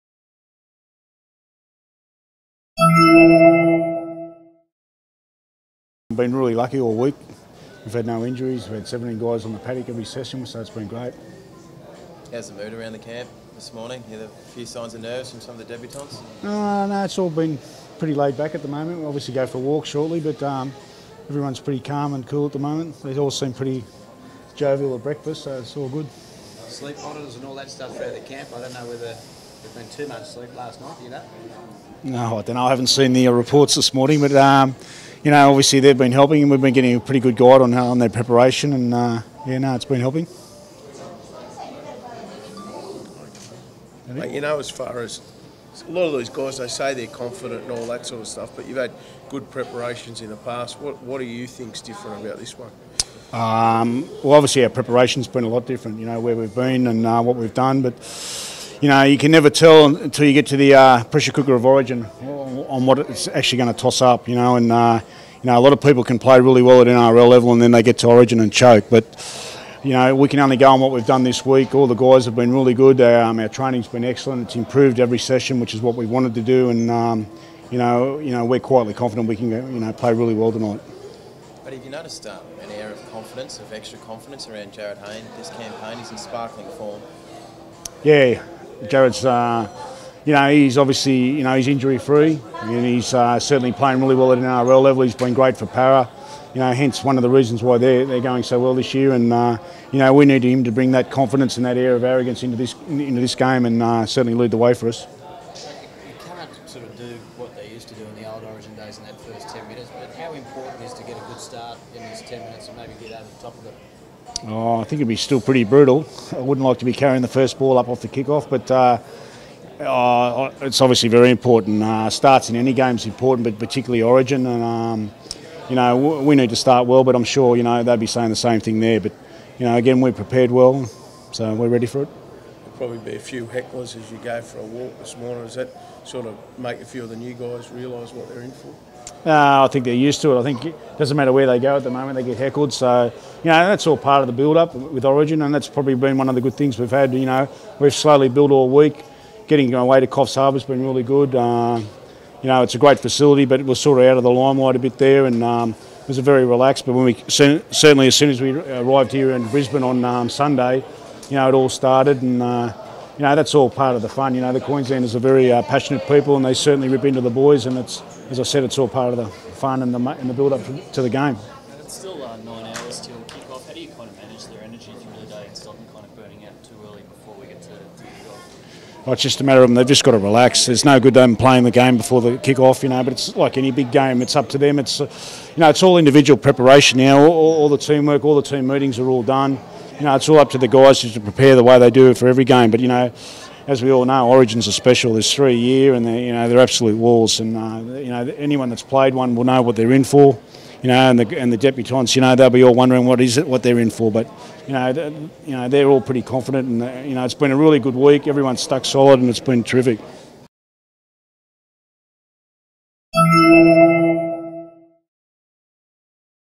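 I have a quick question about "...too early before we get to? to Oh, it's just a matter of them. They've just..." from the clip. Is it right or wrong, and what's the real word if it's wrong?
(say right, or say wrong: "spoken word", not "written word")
right.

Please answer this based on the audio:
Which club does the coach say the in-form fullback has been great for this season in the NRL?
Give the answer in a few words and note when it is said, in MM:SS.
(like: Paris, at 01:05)
Parra, at 01:35.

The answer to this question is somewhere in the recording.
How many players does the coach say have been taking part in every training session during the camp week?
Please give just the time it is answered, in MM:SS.
00:08.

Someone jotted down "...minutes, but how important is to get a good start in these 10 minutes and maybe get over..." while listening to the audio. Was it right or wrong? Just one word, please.
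right.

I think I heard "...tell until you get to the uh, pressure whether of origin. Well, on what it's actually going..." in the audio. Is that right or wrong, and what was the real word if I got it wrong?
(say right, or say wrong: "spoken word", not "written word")
wrong: "cooker", not "whether".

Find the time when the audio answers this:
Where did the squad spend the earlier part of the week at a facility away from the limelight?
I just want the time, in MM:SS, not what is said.
02:30.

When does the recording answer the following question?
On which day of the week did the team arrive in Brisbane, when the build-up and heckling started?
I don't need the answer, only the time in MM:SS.
02:40.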